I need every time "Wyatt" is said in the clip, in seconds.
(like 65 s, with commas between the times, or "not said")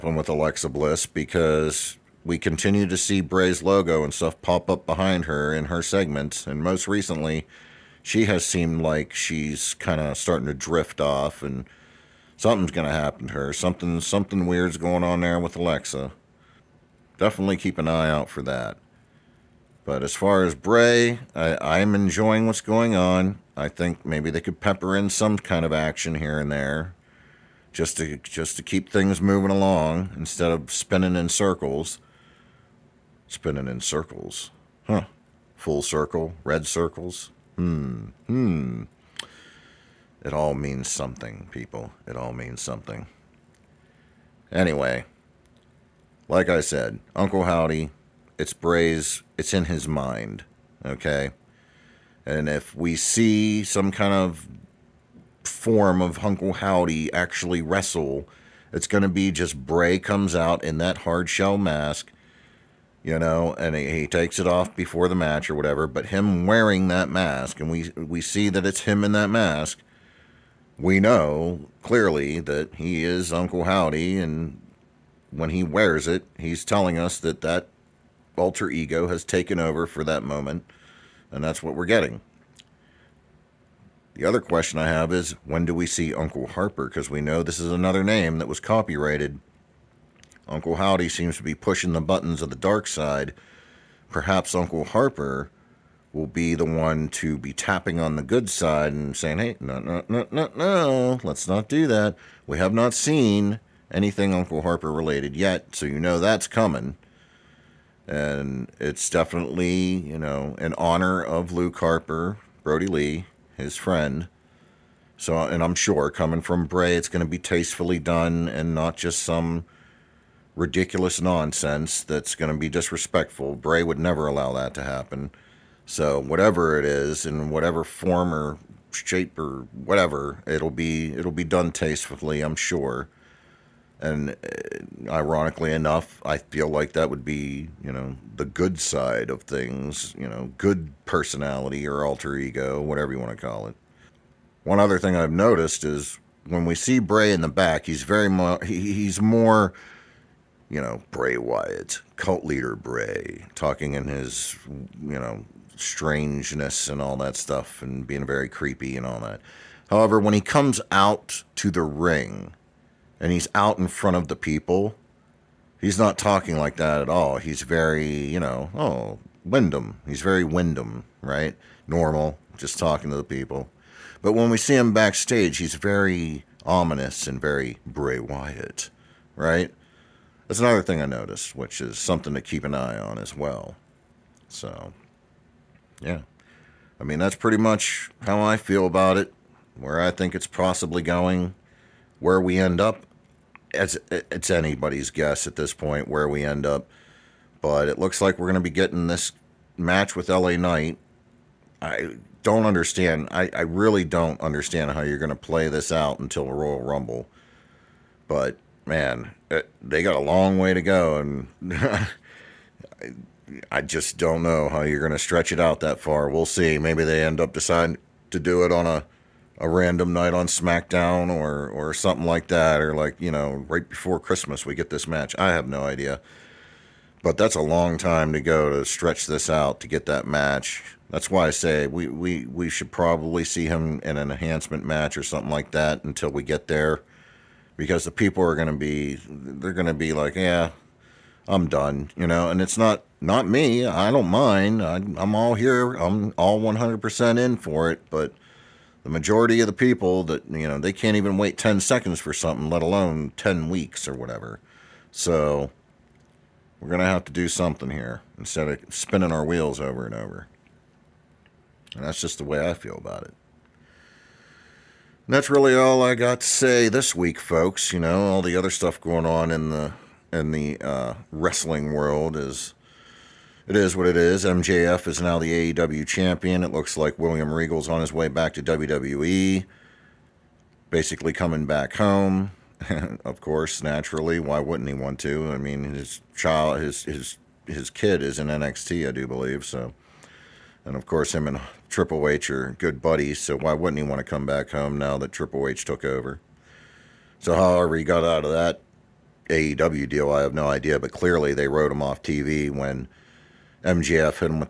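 151 s, 178 s.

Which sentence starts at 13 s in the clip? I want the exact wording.
Something something weird's going on there with Alexa.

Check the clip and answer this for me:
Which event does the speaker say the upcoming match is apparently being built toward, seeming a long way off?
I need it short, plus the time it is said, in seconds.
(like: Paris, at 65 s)
Royal Rumble, at 206 s.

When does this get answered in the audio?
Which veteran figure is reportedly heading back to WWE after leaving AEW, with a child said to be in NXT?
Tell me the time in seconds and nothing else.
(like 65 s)
277 s.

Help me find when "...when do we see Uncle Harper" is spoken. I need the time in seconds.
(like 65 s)
85 s.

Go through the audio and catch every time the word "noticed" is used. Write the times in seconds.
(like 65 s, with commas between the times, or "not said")
145 s, 181 s.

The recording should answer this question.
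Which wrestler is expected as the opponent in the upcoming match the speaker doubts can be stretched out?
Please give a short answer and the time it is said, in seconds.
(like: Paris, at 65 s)
LA Knight, at 200 s.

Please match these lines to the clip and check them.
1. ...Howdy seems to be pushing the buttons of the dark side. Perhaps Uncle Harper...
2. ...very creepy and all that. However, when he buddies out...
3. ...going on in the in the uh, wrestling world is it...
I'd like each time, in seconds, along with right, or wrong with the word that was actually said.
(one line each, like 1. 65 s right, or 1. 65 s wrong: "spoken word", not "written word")
1. 90 s right
2. 158 s wrong: "comes", not "buddies"
3. 268 s right.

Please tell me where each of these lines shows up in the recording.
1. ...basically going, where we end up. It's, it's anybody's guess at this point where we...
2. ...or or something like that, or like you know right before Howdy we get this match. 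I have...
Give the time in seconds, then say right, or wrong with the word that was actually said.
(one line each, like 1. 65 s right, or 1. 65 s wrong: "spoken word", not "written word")
1. 190 s wrong: "possibly", not "basically"
2. 221 s wrong: "Christmas", not "Howdy".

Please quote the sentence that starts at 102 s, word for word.
We have not seen anything Uncle Harper related yet, so you know that's coming.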